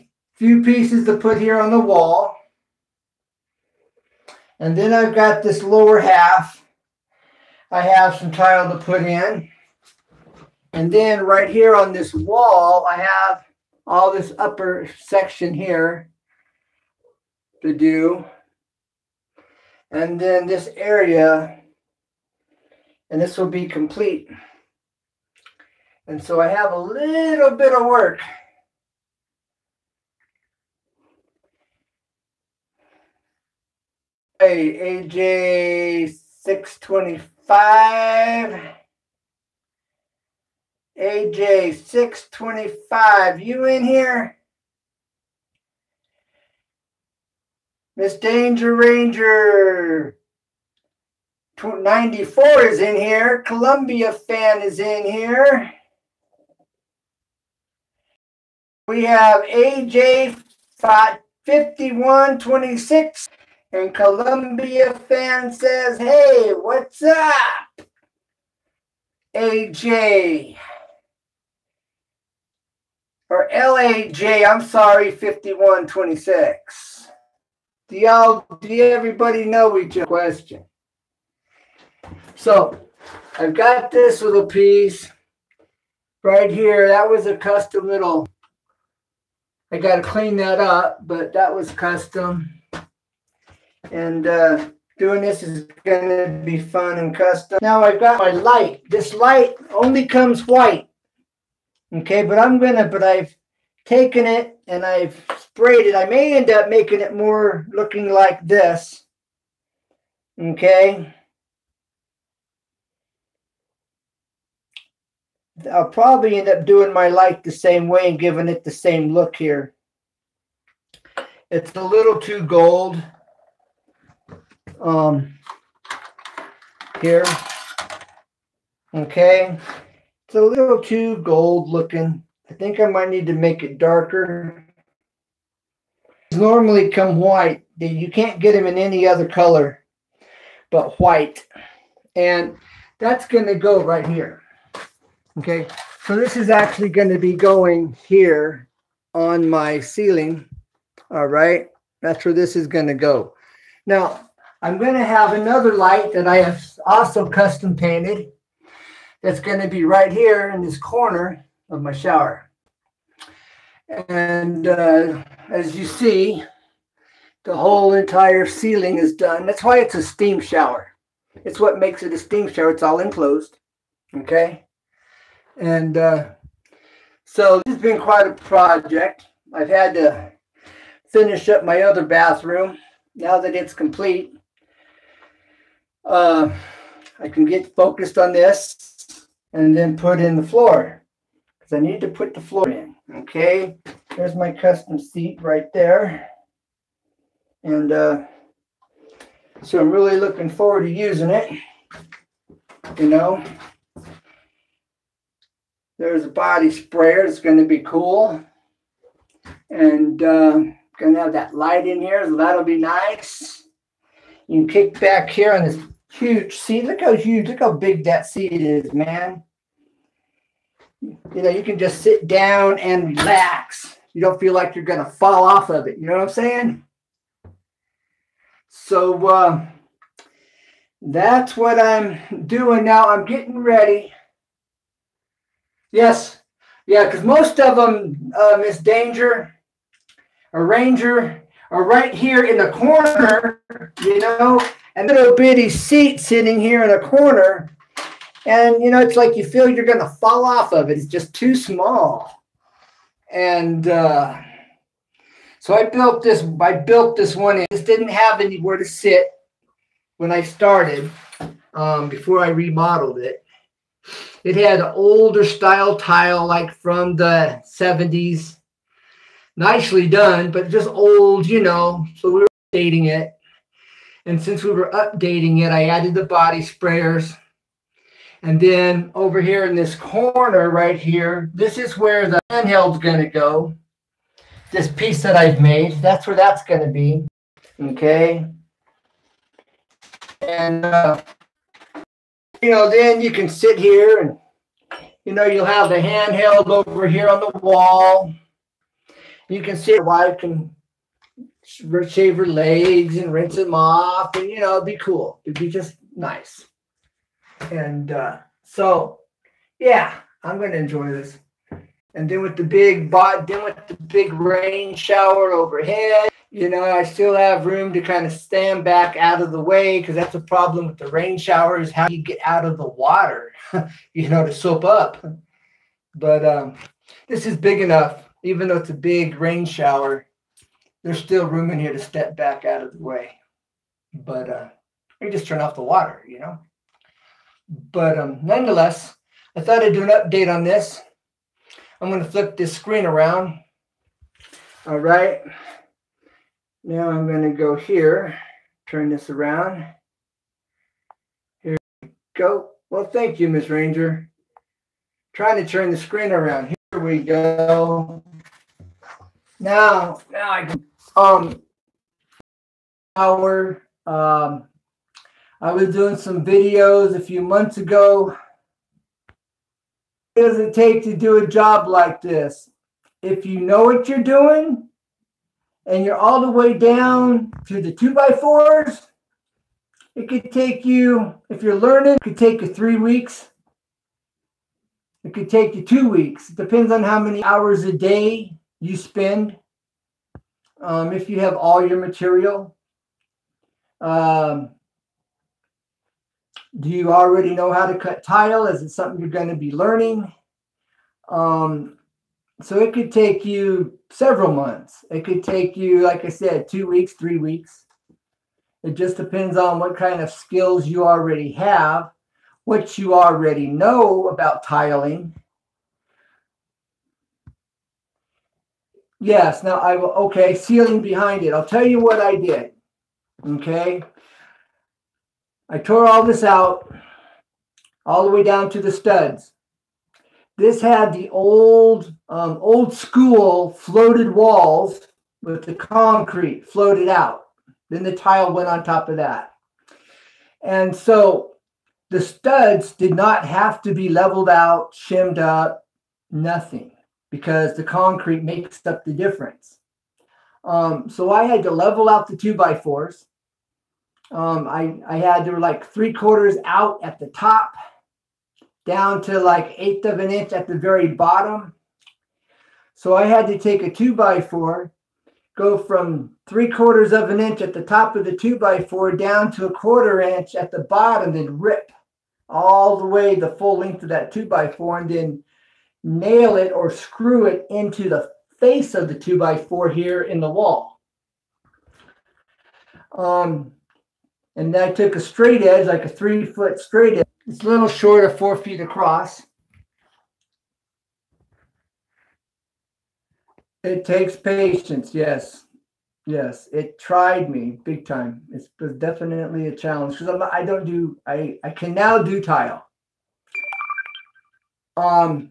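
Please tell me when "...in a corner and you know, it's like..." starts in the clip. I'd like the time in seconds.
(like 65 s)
246 s.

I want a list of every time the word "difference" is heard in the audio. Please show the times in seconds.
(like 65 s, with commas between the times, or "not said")
449 s.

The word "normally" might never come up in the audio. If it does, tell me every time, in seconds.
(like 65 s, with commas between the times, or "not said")
136 s.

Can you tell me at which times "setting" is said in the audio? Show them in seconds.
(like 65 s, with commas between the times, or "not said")
not said.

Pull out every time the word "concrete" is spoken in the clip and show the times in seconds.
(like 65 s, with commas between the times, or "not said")
435 s, 447 s.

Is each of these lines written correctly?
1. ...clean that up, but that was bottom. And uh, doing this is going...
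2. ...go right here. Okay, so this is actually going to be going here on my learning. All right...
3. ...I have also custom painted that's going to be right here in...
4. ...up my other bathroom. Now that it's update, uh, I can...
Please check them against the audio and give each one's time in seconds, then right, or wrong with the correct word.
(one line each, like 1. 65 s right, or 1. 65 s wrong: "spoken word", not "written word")
1. 90 s wrong: "custom", not "bottom"
2. 143 s wrong: "ceiling", not "learning"
3. 156 s right
4. 181 s wrong: "complete", not "update".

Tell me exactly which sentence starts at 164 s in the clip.
And uh, as you see, the whole entire ceiling is done.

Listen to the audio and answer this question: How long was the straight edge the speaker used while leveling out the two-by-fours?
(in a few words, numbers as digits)
3 foot.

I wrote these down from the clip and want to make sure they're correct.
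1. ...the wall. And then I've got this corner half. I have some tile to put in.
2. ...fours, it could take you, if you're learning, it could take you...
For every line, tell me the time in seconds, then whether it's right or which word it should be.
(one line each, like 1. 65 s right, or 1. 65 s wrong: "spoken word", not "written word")
1. 1 s wrong: "lower", not "corner"
2. 378 s right.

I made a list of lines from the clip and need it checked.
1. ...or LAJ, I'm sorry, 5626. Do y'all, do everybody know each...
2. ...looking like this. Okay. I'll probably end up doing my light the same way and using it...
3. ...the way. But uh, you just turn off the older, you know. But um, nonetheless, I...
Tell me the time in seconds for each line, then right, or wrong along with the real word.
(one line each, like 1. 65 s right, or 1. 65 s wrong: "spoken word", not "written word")
1. 73 s wrong: "5126", not "5626"
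2. 107 s wrong: "giving", not "using"
3. 332 s wrong: "water", not "older".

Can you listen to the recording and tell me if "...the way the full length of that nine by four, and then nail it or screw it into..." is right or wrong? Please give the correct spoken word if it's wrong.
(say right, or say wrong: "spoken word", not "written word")
wrong: "two", not "nine".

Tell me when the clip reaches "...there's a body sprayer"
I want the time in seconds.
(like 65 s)
205 s.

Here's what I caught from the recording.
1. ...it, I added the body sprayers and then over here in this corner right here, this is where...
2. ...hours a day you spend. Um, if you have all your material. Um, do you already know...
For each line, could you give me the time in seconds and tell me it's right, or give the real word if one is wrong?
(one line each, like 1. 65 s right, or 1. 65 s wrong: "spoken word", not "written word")
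1. 275 s right
2. 387 s right.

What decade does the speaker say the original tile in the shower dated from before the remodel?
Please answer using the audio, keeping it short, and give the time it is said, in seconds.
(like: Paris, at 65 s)
the 70s, at 266 s.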